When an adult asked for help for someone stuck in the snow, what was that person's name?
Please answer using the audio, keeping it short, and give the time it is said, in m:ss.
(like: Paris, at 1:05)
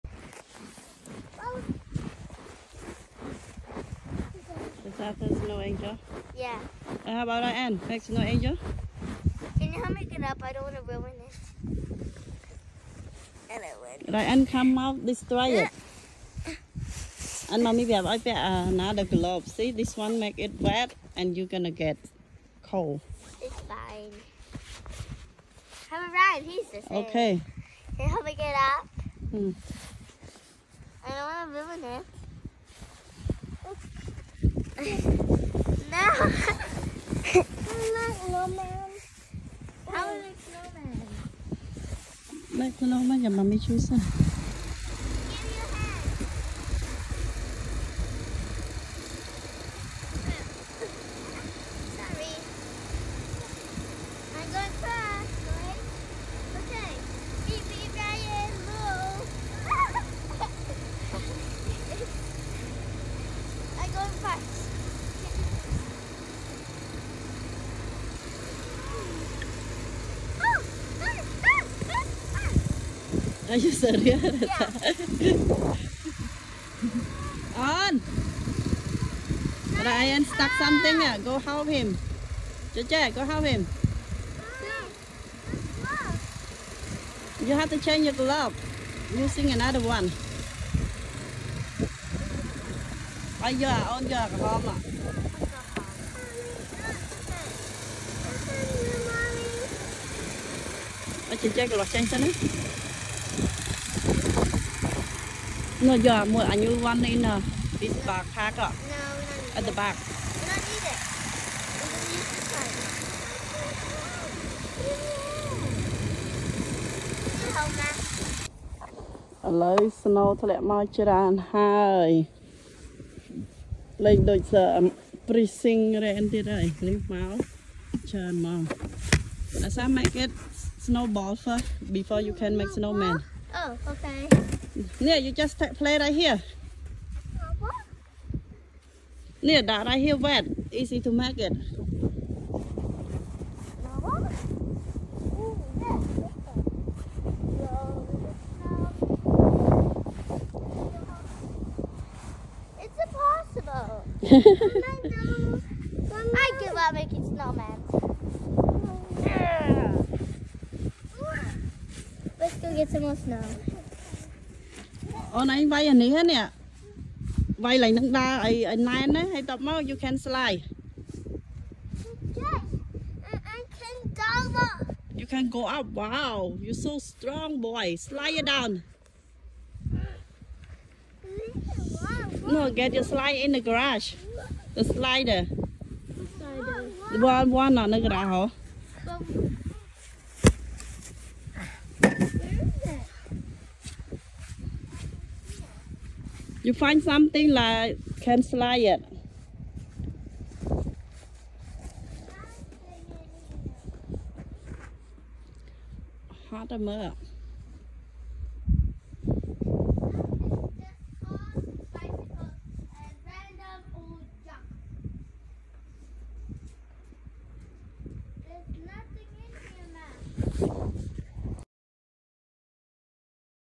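Ryan, at 1:19.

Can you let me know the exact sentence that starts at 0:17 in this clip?
And mommy, we have another glove.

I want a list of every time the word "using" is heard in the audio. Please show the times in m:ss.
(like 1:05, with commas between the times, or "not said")
1:29.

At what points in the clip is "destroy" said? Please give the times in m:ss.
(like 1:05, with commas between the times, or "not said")
0:15.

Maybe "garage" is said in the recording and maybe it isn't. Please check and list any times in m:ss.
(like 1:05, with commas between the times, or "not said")
3:03, 3:07.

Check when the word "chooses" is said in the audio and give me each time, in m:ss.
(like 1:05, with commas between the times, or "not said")
0:43.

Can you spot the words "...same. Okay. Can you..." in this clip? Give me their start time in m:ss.
0:26.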